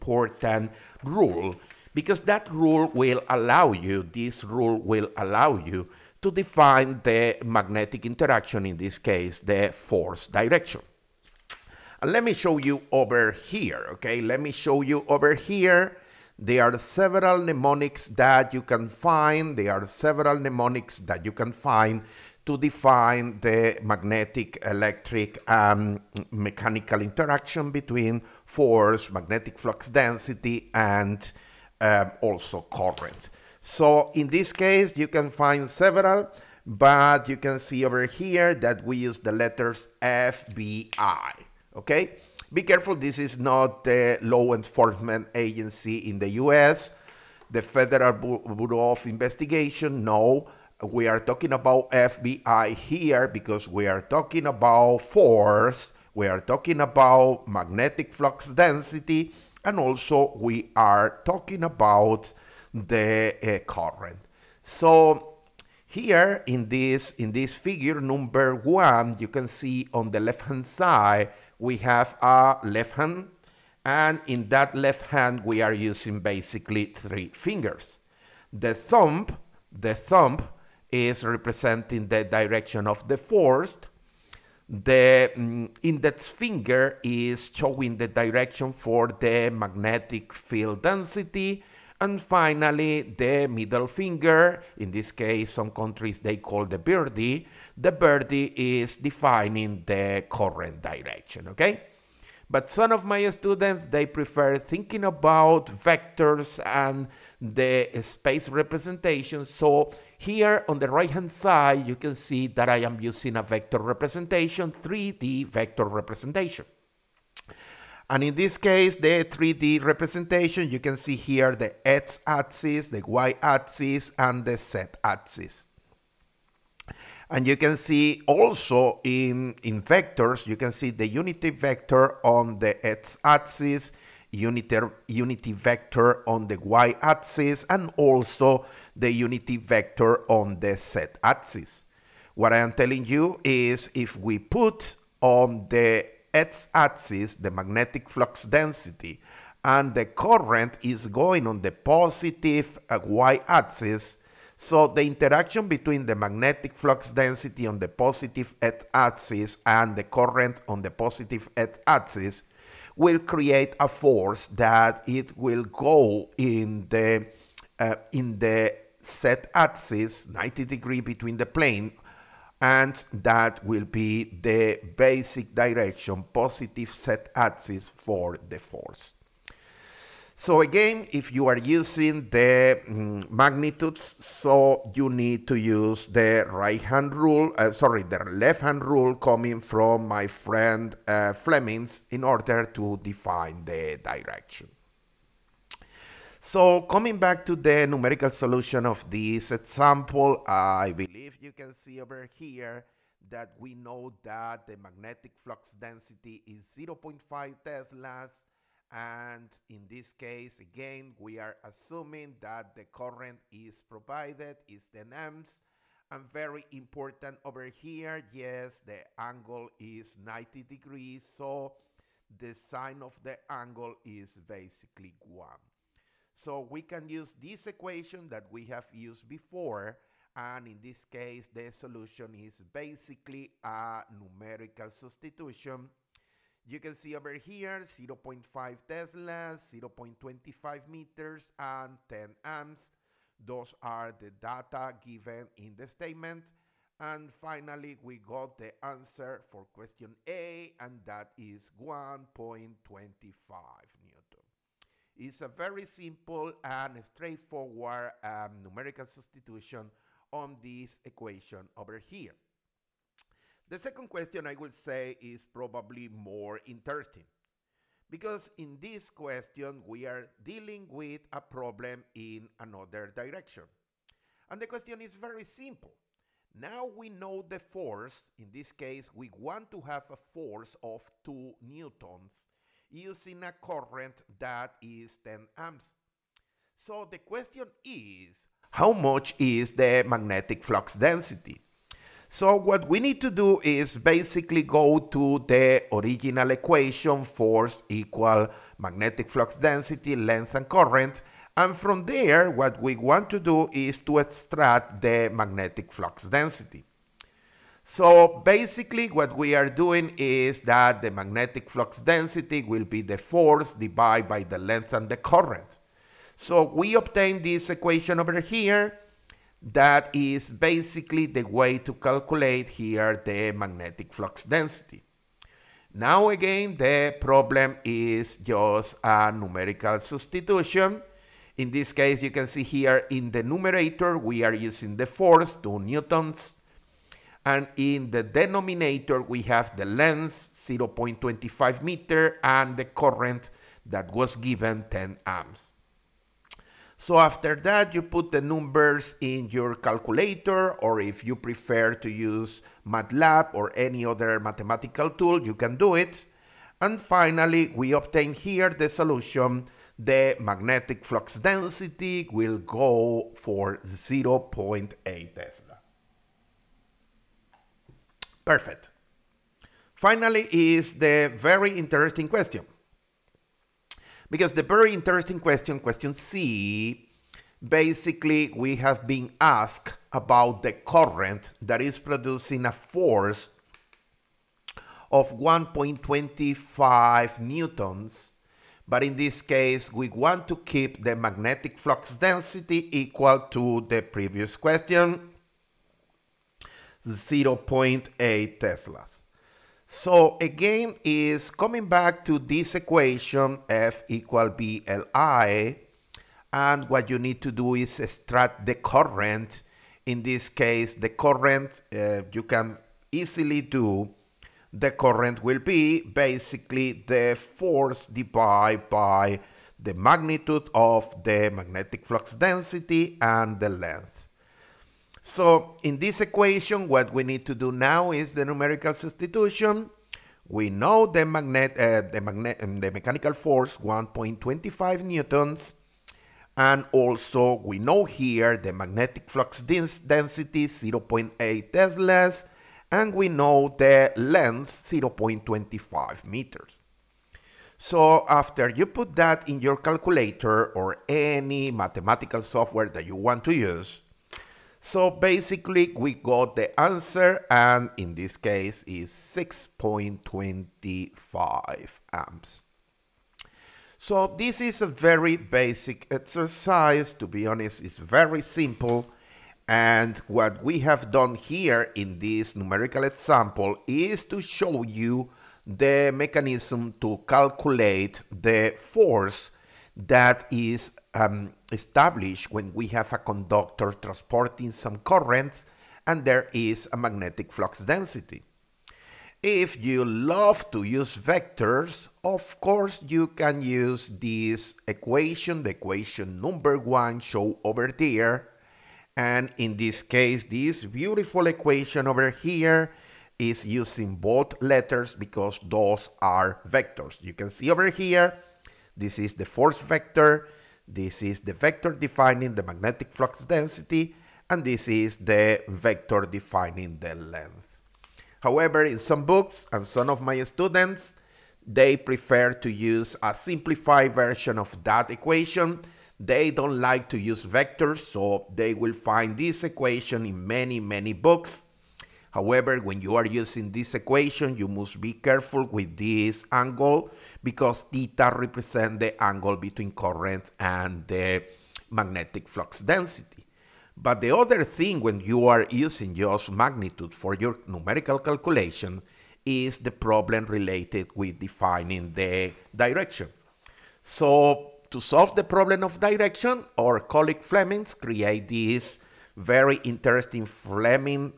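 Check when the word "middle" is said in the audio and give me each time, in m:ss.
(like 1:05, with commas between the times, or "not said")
1:33.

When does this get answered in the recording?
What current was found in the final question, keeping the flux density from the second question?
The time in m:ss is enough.
7:39.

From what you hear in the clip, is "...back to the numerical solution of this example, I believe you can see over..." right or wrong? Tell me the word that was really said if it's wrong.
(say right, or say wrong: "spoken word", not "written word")
right.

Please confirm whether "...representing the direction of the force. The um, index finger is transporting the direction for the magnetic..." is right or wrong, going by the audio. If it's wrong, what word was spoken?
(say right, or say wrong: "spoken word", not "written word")
wrong: "showing", not "transporting".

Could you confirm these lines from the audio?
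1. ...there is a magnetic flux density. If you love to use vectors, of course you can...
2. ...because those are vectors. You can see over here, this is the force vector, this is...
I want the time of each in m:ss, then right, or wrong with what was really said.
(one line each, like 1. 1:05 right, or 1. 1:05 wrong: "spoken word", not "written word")
1. 8:06 right
2. 8:25 right.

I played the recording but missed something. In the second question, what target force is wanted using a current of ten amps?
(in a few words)
2 newtons.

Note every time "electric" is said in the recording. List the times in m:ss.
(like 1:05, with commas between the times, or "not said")
0:24.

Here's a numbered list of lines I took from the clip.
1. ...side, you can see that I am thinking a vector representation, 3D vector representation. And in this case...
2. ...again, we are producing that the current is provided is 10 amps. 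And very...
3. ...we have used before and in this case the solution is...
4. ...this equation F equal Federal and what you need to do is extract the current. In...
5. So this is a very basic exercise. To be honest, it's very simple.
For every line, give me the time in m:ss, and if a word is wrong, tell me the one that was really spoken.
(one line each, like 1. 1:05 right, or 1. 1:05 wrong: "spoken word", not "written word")
1. 1:51 wrong: "using", not "thinking"
2. 3:30 wrong: "assuming", not "producing"
3. 3:48 right
4. 6:42 wrong: "BLI", not "Federal"
5. 7:43 right.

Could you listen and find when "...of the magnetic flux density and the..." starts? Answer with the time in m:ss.
7:00.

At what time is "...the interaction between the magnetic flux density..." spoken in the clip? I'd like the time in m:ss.
2:34.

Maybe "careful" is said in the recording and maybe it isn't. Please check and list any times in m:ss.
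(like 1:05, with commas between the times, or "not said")
0:42, 8:55.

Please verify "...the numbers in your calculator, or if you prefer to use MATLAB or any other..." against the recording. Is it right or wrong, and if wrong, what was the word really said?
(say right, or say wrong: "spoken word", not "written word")
right.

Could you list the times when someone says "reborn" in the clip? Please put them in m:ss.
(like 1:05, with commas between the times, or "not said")
not said.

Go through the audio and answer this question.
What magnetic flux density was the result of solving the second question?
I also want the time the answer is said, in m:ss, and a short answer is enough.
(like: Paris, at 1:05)
0.8 Tesla, at 6:03.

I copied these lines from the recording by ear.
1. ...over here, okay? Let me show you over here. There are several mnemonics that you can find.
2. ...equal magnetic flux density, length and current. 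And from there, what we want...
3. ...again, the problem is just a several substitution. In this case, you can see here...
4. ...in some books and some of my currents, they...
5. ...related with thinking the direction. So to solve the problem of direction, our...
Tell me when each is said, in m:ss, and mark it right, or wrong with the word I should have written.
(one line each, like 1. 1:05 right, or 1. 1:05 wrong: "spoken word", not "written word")
1. 0:12 right
2. 4:57 right
3. 5:26 wrong: "numerical", not "several"
4. 8:38 wrong: "students", not "currents"
5. 9:10 wrong: "defining", not "thinking".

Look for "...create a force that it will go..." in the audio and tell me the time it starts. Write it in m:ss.
2:43.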